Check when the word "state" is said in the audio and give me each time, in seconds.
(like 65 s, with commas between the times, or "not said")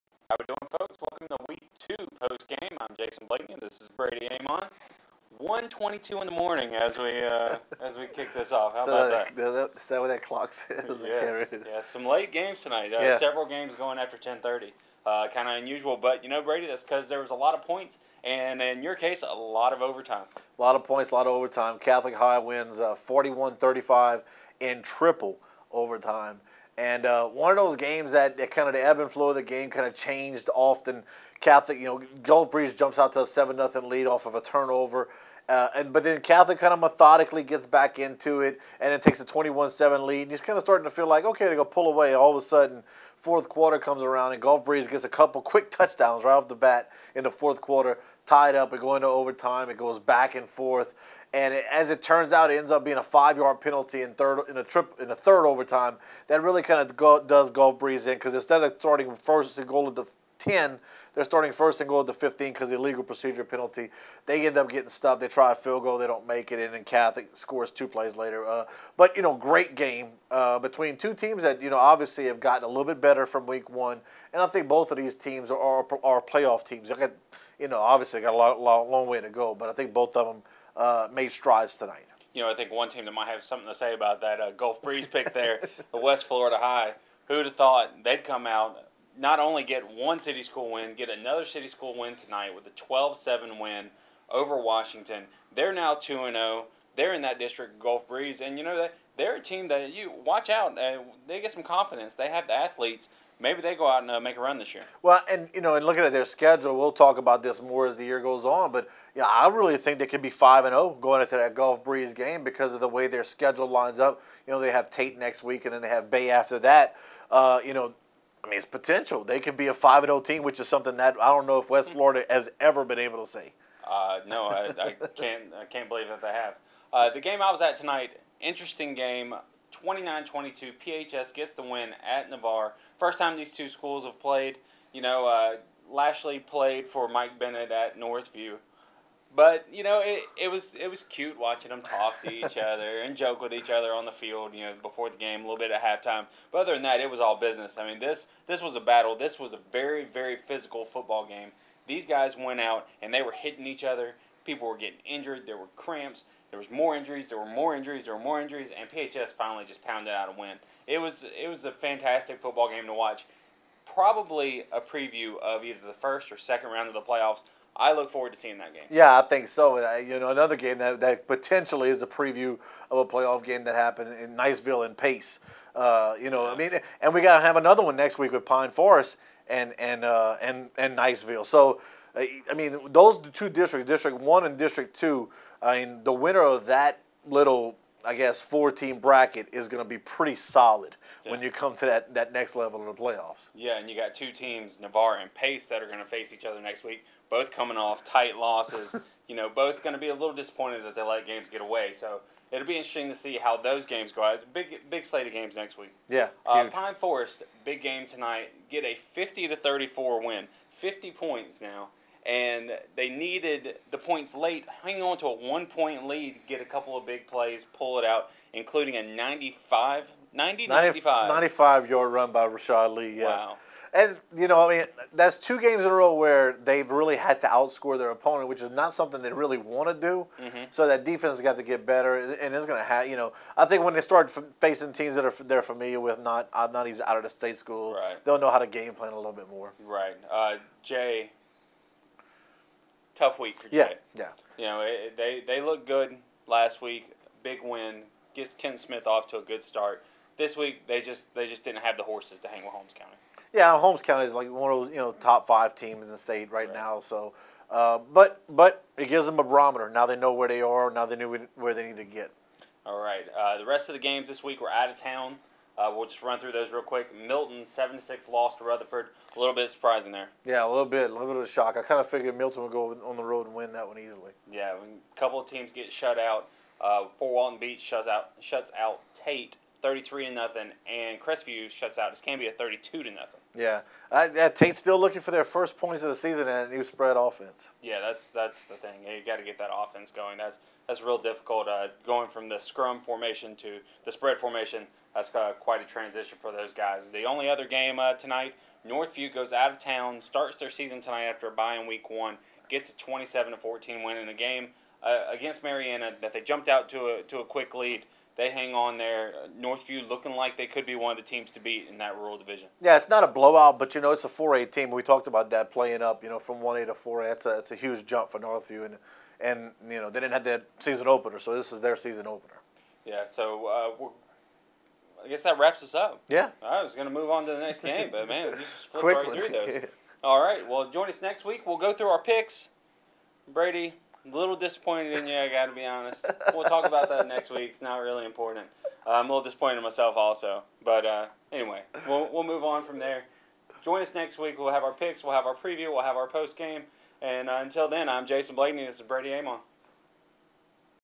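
237 s, 256 s.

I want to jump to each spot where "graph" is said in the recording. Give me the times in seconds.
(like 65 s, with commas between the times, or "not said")
not said.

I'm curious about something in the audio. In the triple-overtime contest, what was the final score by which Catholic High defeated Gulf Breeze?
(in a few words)
41-35.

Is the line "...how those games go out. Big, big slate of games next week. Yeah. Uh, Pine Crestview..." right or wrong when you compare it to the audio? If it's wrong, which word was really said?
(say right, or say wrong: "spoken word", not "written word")
wrong: "Forest", not "Crestview".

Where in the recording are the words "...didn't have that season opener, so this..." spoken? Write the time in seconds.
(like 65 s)
320 s.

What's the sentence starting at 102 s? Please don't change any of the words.
They have the athletes maybe they go out and uh, make a run this year.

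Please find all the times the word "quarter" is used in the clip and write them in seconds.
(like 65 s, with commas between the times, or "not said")
43 s, 47 s.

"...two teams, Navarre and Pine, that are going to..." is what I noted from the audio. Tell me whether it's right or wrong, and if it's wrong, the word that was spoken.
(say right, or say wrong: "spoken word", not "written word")
wrong: "Pace", not "Pine".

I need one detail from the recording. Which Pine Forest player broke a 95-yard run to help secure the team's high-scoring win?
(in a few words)
Rashad Lee.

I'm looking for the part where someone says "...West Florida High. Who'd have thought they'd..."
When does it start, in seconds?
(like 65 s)
85 s.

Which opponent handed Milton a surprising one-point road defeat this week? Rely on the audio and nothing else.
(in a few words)
Rutherford.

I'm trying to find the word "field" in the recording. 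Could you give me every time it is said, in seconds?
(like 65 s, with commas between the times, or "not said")
65 s, 144 s.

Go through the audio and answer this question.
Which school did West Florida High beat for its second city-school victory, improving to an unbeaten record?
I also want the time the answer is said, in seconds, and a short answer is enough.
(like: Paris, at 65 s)
Washington, at 94 s.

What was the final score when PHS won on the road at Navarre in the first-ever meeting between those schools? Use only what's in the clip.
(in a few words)
29-22.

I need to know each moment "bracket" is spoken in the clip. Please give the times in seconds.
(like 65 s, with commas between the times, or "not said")
188 s.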